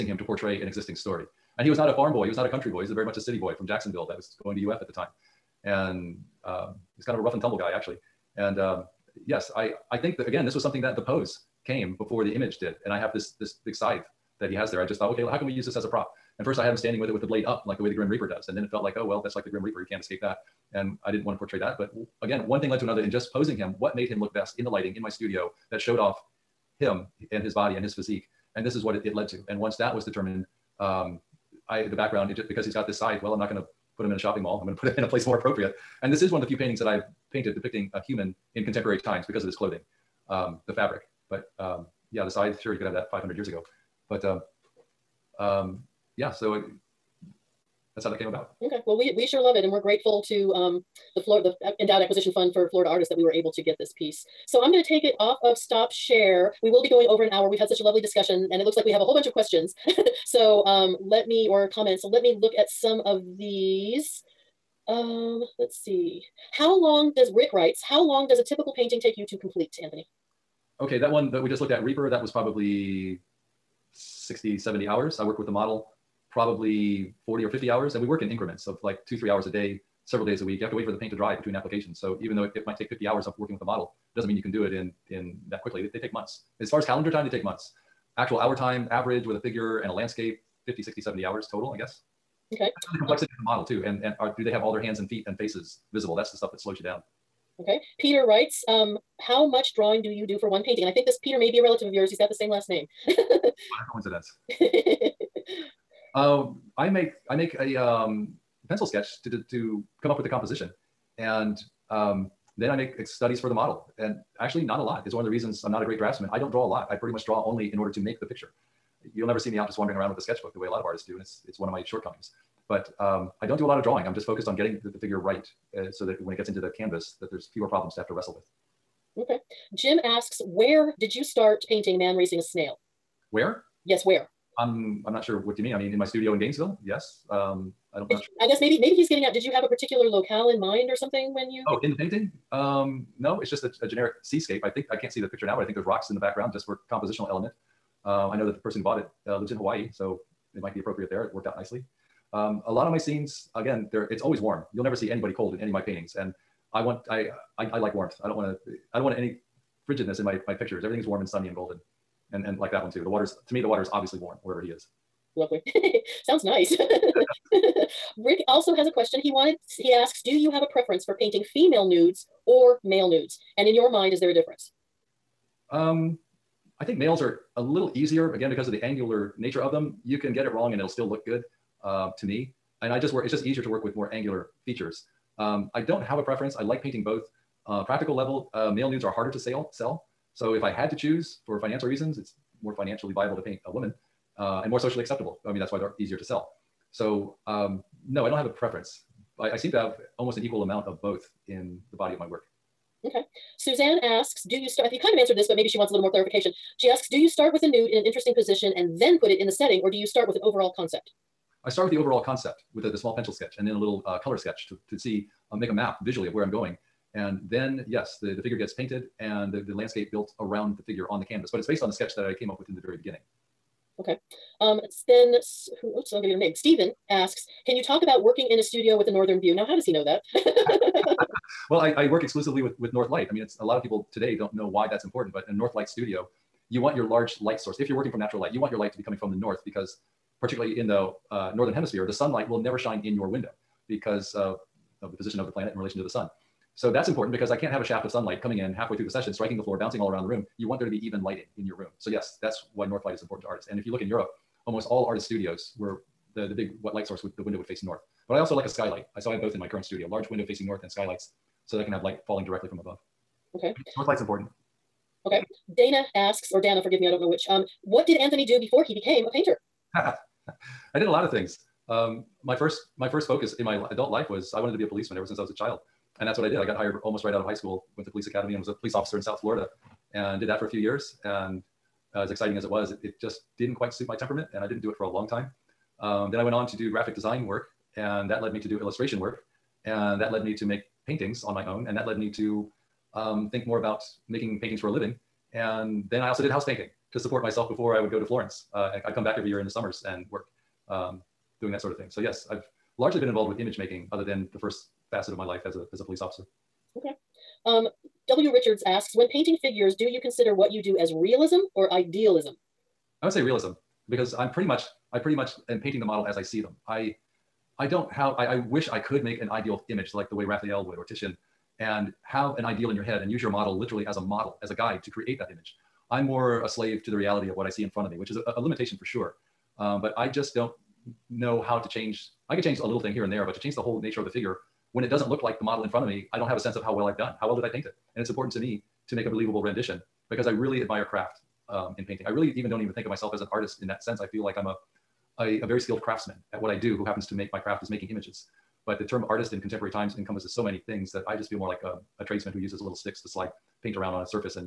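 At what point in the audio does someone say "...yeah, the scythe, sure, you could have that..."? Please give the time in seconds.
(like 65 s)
42 s.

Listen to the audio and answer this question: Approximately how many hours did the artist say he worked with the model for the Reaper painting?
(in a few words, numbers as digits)
40 or 50 hours.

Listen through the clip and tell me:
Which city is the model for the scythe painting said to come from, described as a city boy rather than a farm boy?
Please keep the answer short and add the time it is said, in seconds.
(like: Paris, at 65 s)
Jacksonville, at 3 s.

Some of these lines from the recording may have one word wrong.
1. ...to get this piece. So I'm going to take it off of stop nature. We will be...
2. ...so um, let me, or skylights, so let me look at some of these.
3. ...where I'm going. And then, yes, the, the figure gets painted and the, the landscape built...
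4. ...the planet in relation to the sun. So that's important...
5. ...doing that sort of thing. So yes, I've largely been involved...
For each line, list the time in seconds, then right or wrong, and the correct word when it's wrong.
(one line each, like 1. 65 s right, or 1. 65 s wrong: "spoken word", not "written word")
1. 53 s wrong: "share", not "nature"
2. 60 s wrong: "comments", not "skylights"
3. 216 s right
4. 245 s right
5. 301 s right.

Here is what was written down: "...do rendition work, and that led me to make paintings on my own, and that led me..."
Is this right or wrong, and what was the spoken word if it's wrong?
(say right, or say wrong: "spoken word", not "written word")
wrong: "illustration", not "rendition".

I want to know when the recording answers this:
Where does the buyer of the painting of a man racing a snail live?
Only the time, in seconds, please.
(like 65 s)
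149 s.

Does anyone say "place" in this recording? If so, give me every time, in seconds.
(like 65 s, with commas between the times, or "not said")
35 s.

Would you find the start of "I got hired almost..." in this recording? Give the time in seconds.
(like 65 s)
276 s.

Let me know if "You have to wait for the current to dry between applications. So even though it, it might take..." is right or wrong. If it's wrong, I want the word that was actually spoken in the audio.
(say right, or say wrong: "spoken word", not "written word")
wrong: "paint", not "current".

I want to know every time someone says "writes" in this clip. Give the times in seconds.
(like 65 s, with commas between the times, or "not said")
67 s, 98 s.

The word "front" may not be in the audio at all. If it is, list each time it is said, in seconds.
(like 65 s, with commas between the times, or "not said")
327 s, 335 s.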